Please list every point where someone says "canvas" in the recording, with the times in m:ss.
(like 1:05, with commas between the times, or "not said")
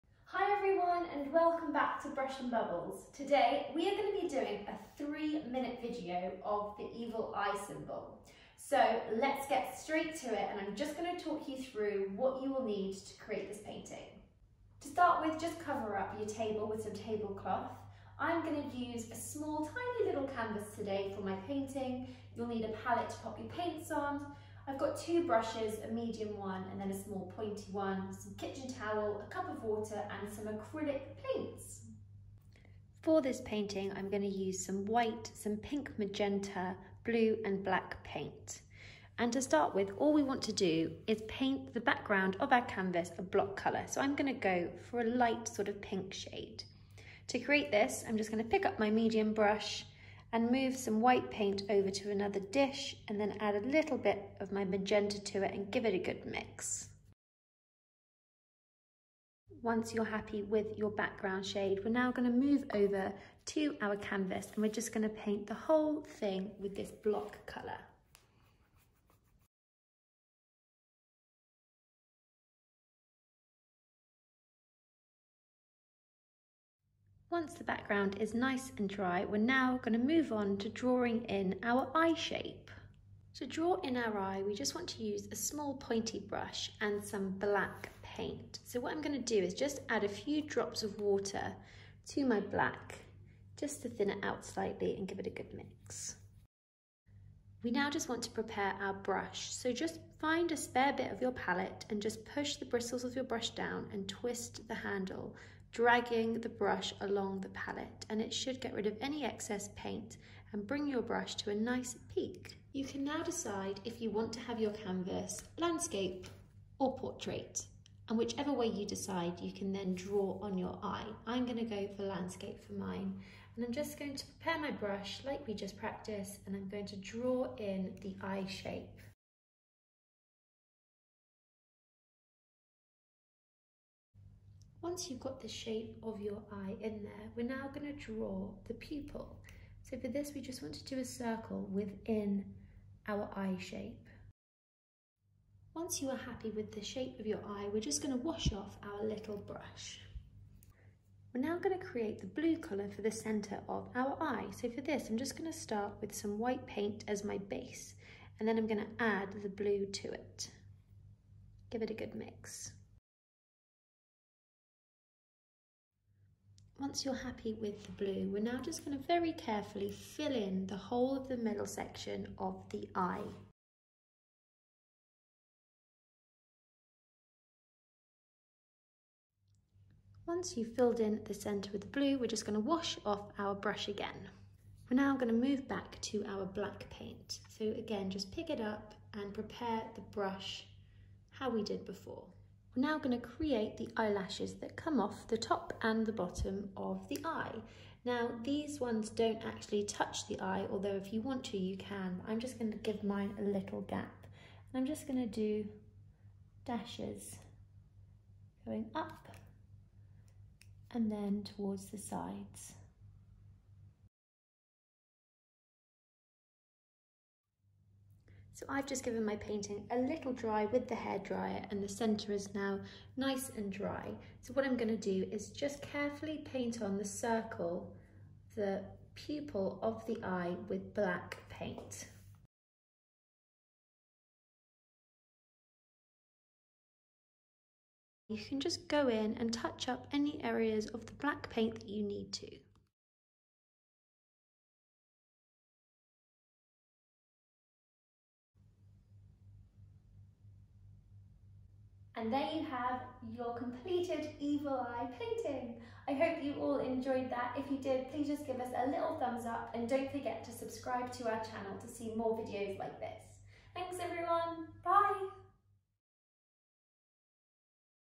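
0:20, 0:42, 1:03, 1:54.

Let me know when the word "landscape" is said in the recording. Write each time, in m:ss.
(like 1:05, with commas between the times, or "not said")
1:55, 2:02.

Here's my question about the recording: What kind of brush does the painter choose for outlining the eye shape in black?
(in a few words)
small pointy brush.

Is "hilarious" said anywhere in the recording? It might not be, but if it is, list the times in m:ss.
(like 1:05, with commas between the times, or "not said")
not said.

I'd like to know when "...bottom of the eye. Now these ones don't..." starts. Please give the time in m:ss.
3:16.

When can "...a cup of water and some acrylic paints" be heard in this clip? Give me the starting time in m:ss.
0:29.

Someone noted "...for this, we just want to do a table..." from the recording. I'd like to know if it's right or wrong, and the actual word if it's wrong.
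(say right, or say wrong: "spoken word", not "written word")
wrong: "circle", not "table".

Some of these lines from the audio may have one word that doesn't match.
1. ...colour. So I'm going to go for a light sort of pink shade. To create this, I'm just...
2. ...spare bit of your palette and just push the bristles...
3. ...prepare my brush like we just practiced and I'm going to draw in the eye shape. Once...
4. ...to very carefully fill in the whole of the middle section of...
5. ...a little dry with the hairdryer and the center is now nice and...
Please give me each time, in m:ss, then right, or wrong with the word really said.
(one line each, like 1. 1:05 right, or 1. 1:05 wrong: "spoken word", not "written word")
1. 0:43 right
2. 1:40 right
3. 2:04 right
4. 2:48 right
5. 3:39 right.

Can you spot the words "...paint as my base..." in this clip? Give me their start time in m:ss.
2:36.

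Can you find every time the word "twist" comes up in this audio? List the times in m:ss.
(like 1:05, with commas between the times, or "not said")
1:44.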